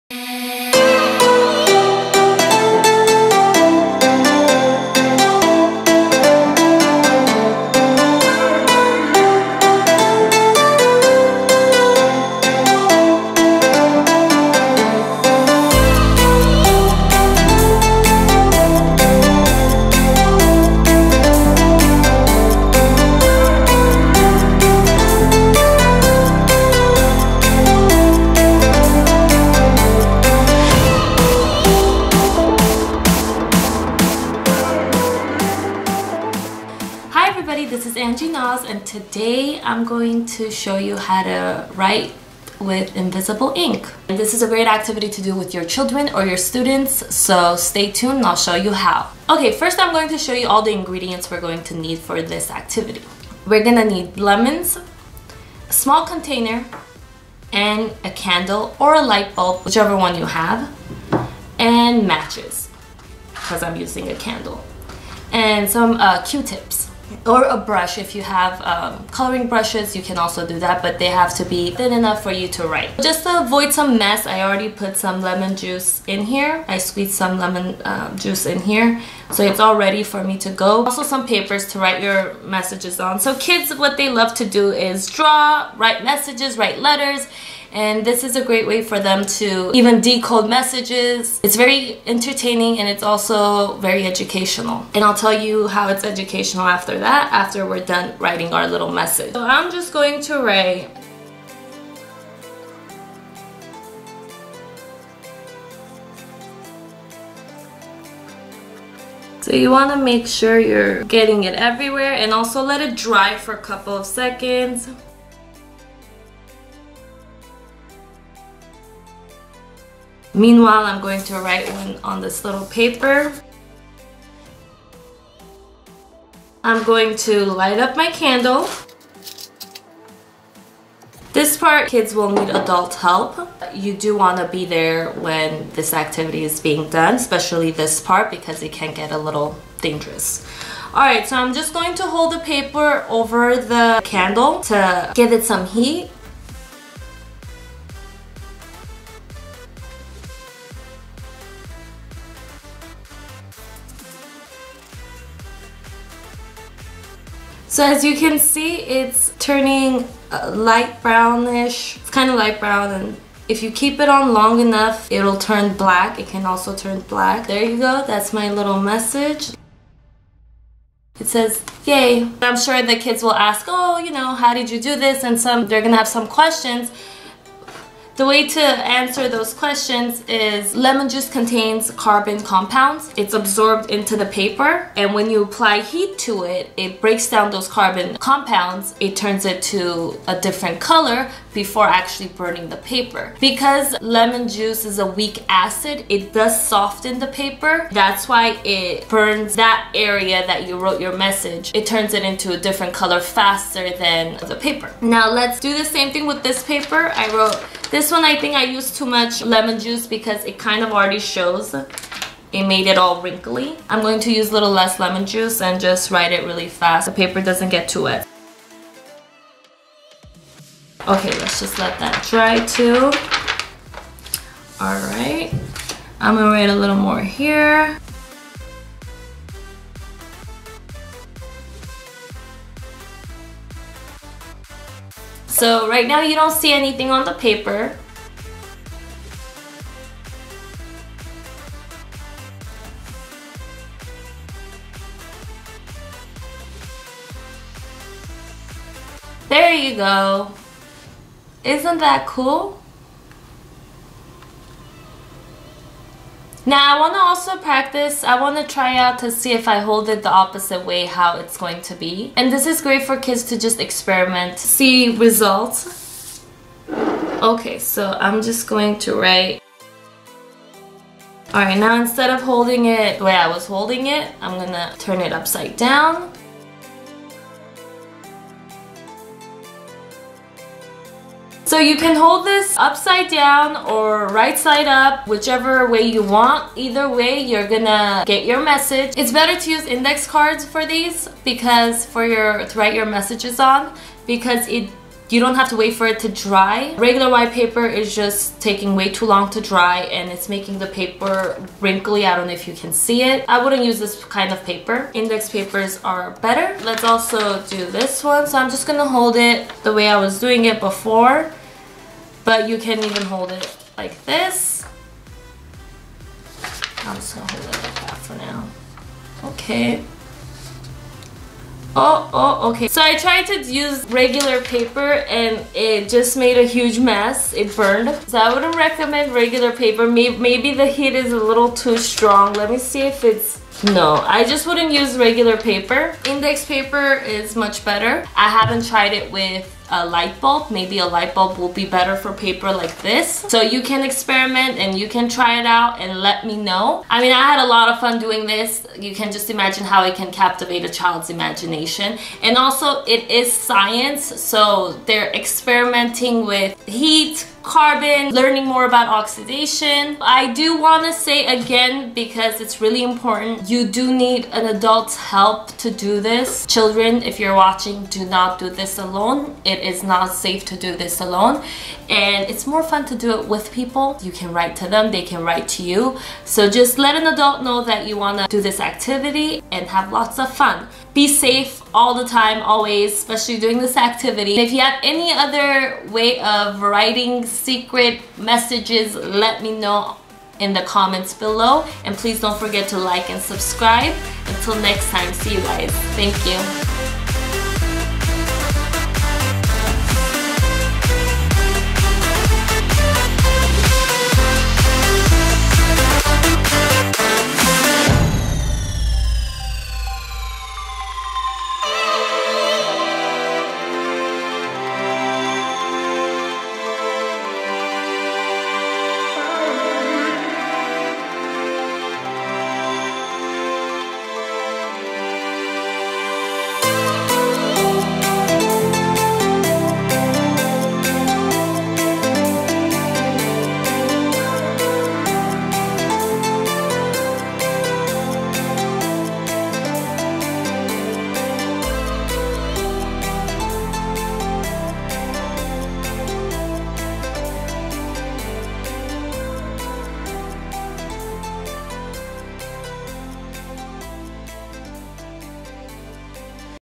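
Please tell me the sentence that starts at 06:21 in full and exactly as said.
Be safe all the time, always, especially doing this activity.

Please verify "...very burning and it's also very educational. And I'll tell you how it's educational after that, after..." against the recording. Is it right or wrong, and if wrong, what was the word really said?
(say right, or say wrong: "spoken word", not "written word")
wrong: "entertaining", not "burning".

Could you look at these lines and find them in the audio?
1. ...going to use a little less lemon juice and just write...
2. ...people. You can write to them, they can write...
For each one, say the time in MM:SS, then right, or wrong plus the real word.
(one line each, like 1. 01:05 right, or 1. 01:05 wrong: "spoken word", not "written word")
1. 03:34 right
2. 06:13 right.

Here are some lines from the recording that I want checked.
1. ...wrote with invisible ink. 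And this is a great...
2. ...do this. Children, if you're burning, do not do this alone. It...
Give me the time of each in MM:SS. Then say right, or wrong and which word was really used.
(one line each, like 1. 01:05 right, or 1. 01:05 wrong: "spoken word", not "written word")
1. 00:41 wrong: "write", not "wrote"
2. 06:05 wrong: "watching", not "burning".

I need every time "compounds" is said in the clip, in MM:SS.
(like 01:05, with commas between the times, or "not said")
03:02, 03:08.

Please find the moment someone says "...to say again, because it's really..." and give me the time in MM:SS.
06:01.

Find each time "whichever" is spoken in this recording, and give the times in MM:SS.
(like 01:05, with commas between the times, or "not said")
00:59, 04:45.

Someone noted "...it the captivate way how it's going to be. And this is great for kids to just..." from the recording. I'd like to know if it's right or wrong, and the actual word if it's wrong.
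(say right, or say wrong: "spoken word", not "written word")
wrong: "opposite", not "captivate".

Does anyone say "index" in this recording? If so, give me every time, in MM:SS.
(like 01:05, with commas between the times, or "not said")
04:49, 05:05, 05:36.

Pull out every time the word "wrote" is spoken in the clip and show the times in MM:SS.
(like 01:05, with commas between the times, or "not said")
03:20, 03:27.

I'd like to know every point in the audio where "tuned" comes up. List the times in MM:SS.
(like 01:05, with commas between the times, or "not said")
00:47.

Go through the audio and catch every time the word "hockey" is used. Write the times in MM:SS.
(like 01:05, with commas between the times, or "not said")
not said.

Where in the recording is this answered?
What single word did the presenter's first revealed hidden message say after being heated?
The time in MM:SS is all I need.
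02:51.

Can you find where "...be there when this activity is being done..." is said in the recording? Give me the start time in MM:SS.
02:14.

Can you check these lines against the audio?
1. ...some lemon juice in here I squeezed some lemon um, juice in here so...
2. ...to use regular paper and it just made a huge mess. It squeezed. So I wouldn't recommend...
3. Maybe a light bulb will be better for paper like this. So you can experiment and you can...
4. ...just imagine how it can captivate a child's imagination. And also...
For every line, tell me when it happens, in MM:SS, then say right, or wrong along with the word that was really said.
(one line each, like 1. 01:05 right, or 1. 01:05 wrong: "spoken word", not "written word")
1. 01:14 right
2. 05:23 wrong: "burned", not "squeezed"
3. 05:40 right
4. 05:49 right.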